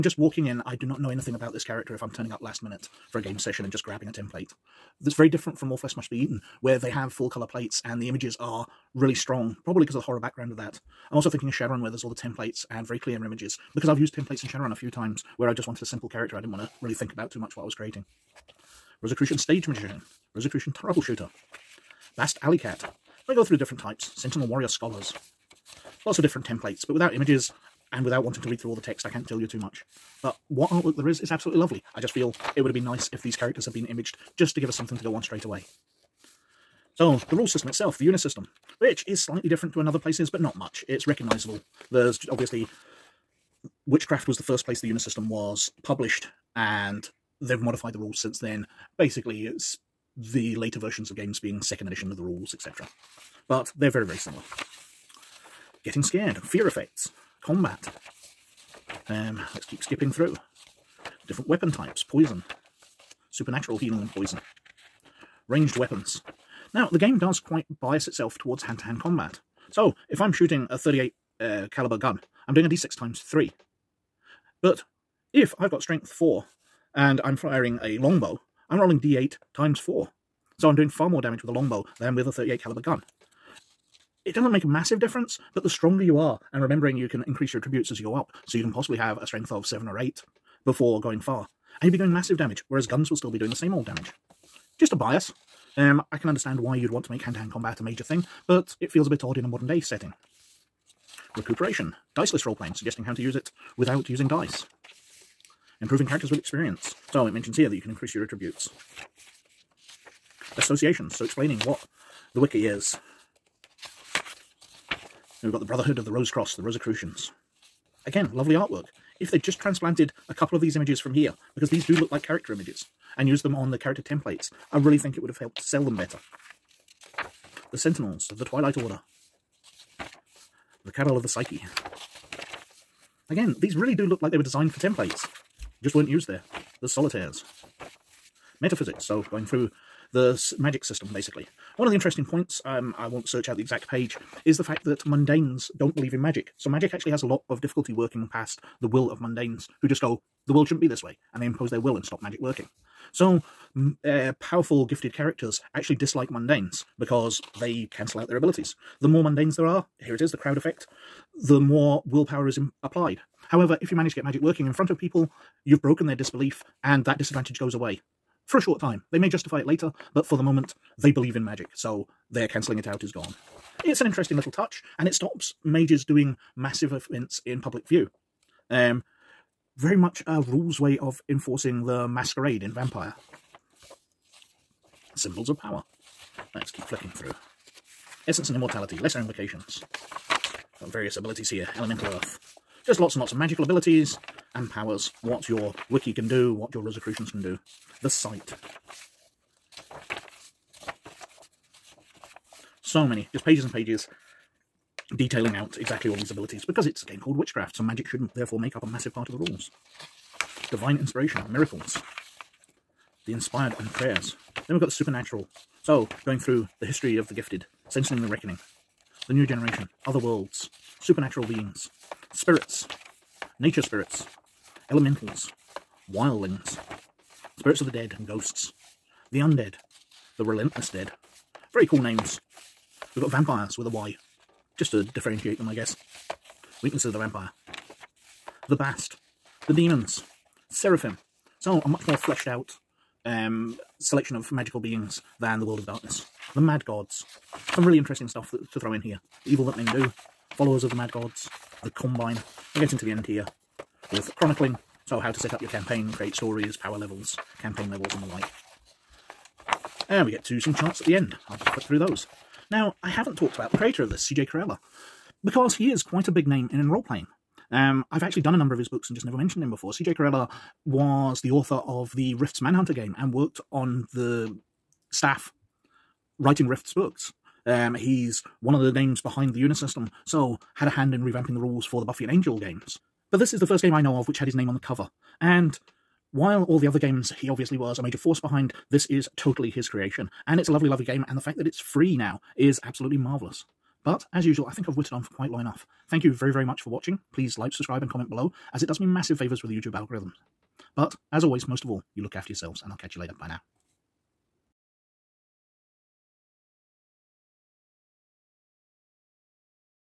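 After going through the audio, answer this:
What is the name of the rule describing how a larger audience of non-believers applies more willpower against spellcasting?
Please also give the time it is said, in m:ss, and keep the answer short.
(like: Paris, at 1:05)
the crowd effect, at 2:40.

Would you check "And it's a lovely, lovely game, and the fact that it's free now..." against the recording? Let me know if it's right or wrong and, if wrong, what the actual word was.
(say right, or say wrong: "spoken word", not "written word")
right.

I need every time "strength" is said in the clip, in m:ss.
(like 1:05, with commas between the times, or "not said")
1:15, 1:29.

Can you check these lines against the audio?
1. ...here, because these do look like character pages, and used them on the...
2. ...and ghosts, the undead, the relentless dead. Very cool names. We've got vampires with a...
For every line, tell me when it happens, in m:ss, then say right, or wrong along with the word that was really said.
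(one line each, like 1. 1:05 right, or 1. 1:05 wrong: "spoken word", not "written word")
1. 2:01 wrong: "images", not "pages"
2. 3:48 right.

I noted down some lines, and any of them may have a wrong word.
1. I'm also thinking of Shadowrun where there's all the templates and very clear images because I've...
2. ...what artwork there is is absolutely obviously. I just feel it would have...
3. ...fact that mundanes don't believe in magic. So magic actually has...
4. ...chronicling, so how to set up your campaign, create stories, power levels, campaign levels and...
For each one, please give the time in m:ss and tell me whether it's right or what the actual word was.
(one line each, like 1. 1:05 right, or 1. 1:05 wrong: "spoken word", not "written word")
1. 0:11 right
2. 0:30 wrong: "lovely", not "obviously"
3. 2:24 right
4. 4:14 right.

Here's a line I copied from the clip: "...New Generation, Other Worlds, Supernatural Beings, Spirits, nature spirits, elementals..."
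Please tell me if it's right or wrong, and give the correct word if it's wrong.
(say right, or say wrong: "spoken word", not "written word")
right.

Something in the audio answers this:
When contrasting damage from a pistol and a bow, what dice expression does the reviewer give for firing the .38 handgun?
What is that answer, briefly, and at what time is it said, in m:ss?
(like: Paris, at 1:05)
d6 times 3, at 1:12.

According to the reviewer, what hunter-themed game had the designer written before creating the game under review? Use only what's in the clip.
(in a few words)
Rifts Manhunter.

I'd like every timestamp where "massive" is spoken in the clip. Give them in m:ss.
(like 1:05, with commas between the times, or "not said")
1:24, 1:32, 2:56, 3:28, 4:59.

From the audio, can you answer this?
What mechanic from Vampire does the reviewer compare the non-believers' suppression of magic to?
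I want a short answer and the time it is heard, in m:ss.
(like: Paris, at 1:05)
the masquerade, at 3:02.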